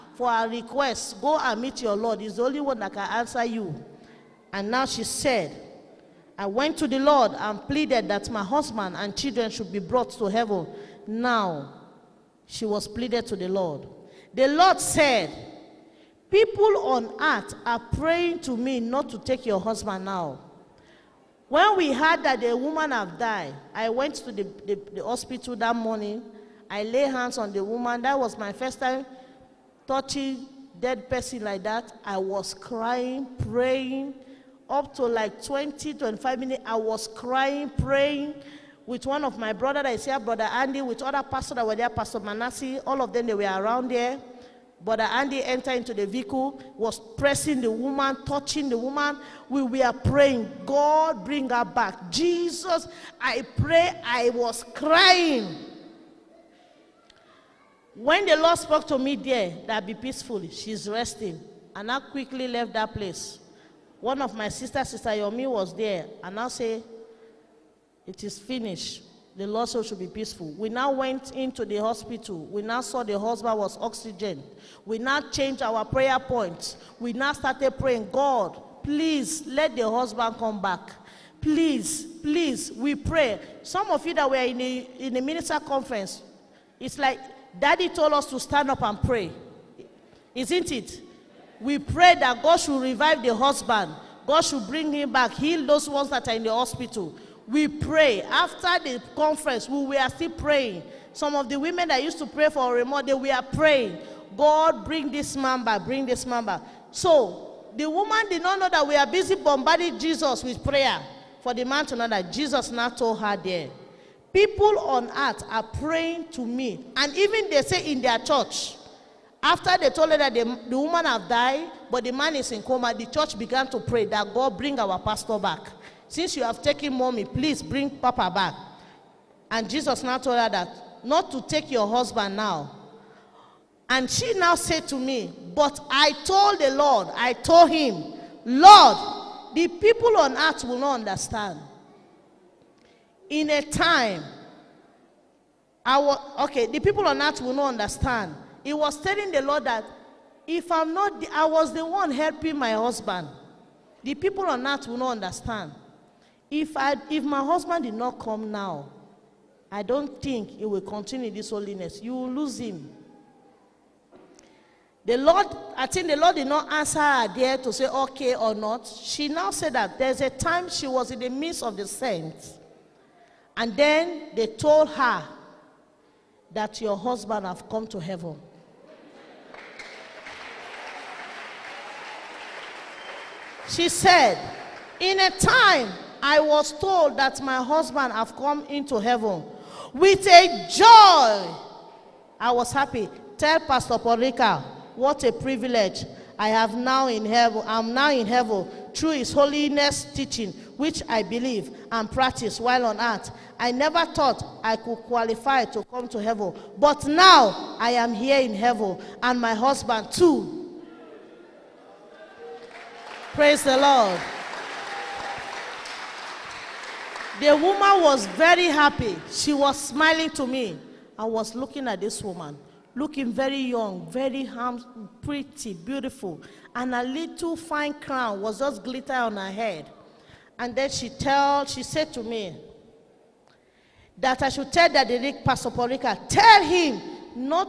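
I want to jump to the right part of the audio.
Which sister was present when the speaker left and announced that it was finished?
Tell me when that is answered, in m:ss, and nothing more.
1:04.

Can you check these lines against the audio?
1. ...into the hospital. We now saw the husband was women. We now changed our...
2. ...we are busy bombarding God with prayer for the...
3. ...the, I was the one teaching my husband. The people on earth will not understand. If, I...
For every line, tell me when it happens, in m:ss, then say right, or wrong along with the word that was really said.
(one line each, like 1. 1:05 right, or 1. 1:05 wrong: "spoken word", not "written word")
1. 1:11 wrong: "oxygen", not "women"
2. 1:48 wrong: "Jesus", not "God"
3. 2:31 wrong: "helping", not "teaching".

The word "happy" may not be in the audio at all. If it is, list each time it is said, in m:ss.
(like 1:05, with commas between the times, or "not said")
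3:12, 3:38.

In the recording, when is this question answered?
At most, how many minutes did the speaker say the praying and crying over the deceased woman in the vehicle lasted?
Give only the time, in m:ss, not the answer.
0:35.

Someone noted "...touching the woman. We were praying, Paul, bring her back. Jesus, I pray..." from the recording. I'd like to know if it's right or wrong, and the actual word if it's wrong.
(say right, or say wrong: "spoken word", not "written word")
wrong: "God", not "Paul".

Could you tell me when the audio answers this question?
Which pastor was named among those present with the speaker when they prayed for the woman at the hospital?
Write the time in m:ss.
0:41.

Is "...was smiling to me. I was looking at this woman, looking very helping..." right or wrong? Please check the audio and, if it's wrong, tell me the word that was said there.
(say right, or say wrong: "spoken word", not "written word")
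wrong: "young", not "helping".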